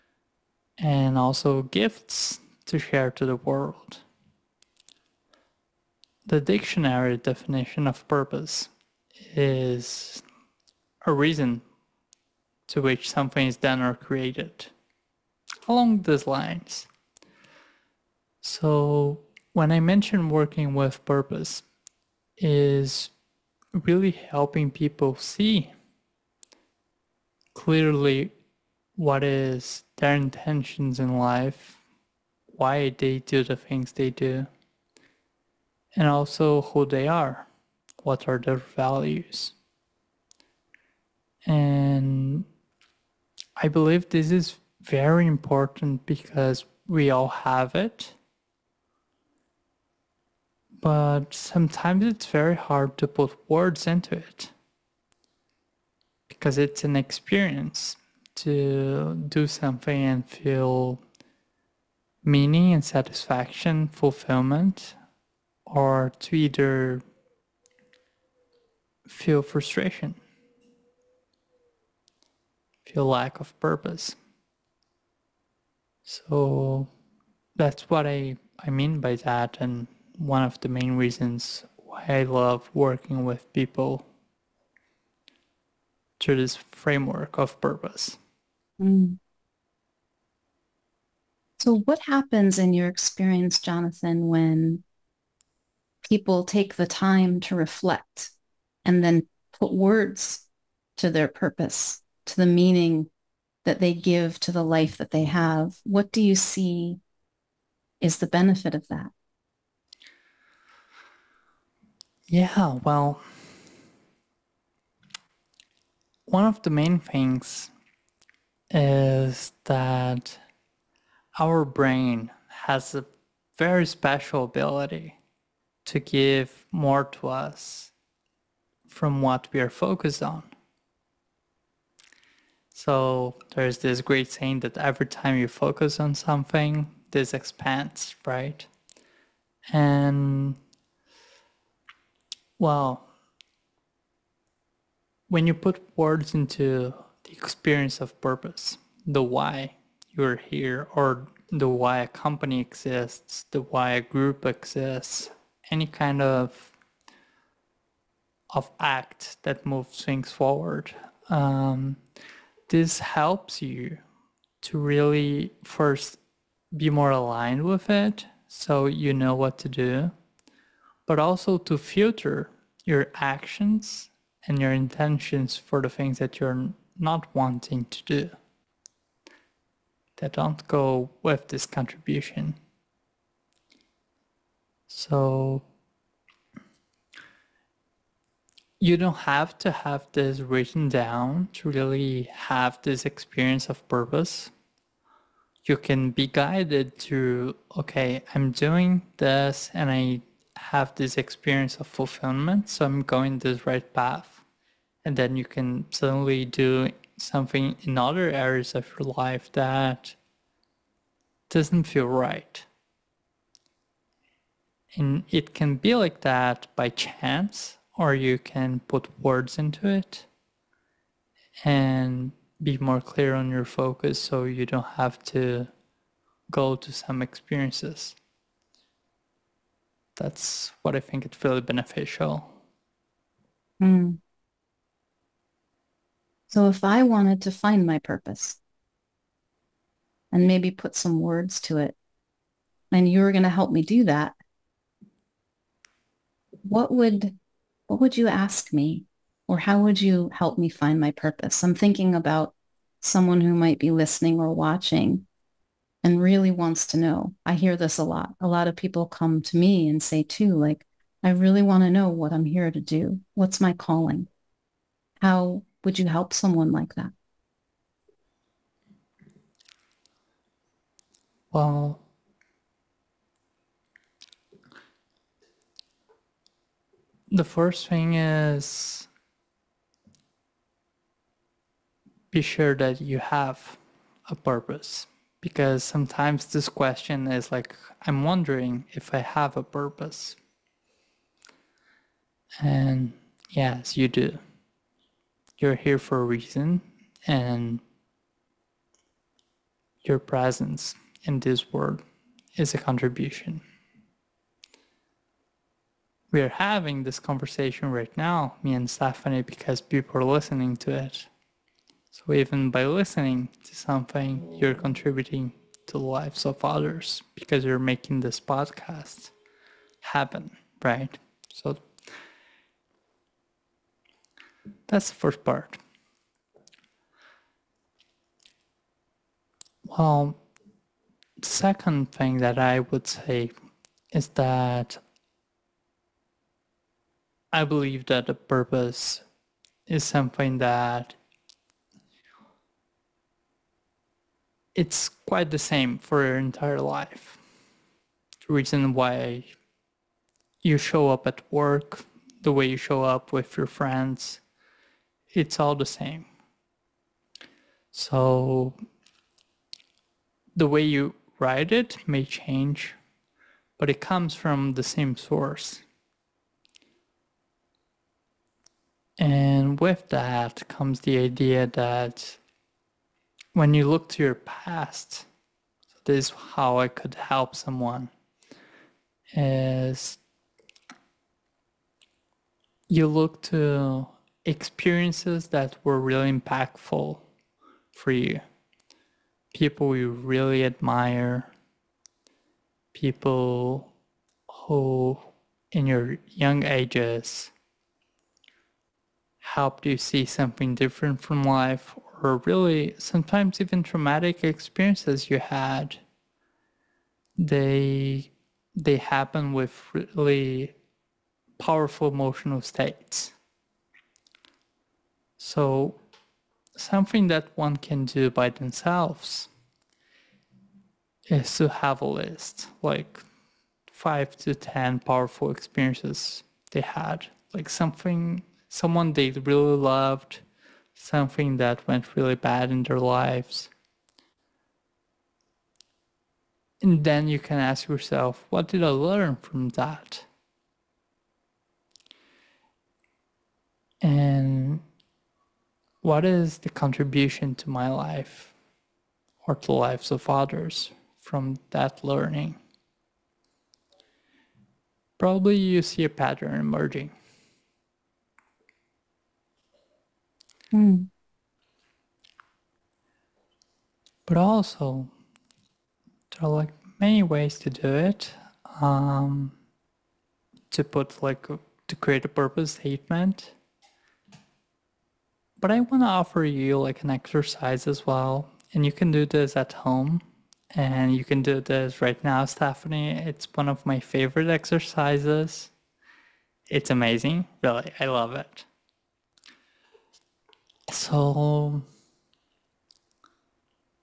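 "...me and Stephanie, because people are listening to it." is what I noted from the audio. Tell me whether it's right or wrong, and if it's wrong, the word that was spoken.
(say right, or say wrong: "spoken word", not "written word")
right.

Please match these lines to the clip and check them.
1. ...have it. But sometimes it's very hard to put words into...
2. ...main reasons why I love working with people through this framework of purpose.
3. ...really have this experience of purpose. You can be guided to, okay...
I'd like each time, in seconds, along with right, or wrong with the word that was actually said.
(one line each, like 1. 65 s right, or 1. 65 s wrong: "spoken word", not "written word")
1. 47 s right
2. 80 s right
3. 191 s right.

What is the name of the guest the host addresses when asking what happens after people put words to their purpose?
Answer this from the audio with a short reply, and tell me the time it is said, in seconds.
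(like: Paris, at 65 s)
Jonathan, at 93 s.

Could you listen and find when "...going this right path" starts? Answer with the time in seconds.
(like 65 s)
203 s.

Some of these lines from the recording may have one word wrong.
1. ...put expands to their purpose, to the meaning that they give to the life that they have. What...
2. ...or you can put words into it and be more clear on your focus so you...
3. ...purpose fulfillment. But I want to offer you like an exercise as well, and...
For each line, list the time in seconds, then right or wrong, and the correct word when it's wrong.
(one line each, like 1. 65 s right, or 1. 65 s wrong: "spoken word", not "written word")
1. 99 s wrong: "words", not "expands"
2. 217 s right
3. 472 s wrong: "statement", not "fulfillment".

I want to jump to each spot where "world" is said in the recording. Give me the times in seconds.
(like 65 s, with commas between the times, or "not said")
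3 s, 301 s.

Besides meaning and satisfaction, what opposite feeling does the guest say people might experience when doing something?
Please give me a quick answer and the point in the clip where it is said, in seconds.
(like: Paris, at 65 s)
Frustration, at 69 s.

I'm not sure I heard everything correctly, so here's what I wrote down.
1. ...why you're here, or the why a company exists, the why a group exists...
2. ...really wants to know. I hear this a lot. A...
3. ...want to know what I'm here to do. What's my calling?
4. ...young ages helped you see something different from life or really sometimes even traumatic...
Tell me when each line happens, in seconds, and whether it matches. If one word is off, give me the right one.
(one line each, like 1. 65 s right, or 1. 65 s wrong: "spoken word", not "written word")
1. 149 s right
2. 256 s right
3. 261 s right
4. 396 s right.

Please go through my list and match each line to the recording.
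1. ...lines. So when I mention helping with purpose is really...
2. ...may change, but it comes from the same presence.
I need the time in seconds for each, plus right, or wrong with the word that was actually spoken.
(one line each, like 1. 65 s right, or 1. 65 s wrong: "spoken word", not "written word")
1. 16 s wrong: "working", not "helping"
2. 362 s wrong: "source", not "presence".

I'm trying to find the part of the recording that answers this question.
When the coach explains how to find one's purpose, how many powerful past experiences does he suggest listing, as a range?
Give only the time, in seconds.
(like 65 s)
423 s.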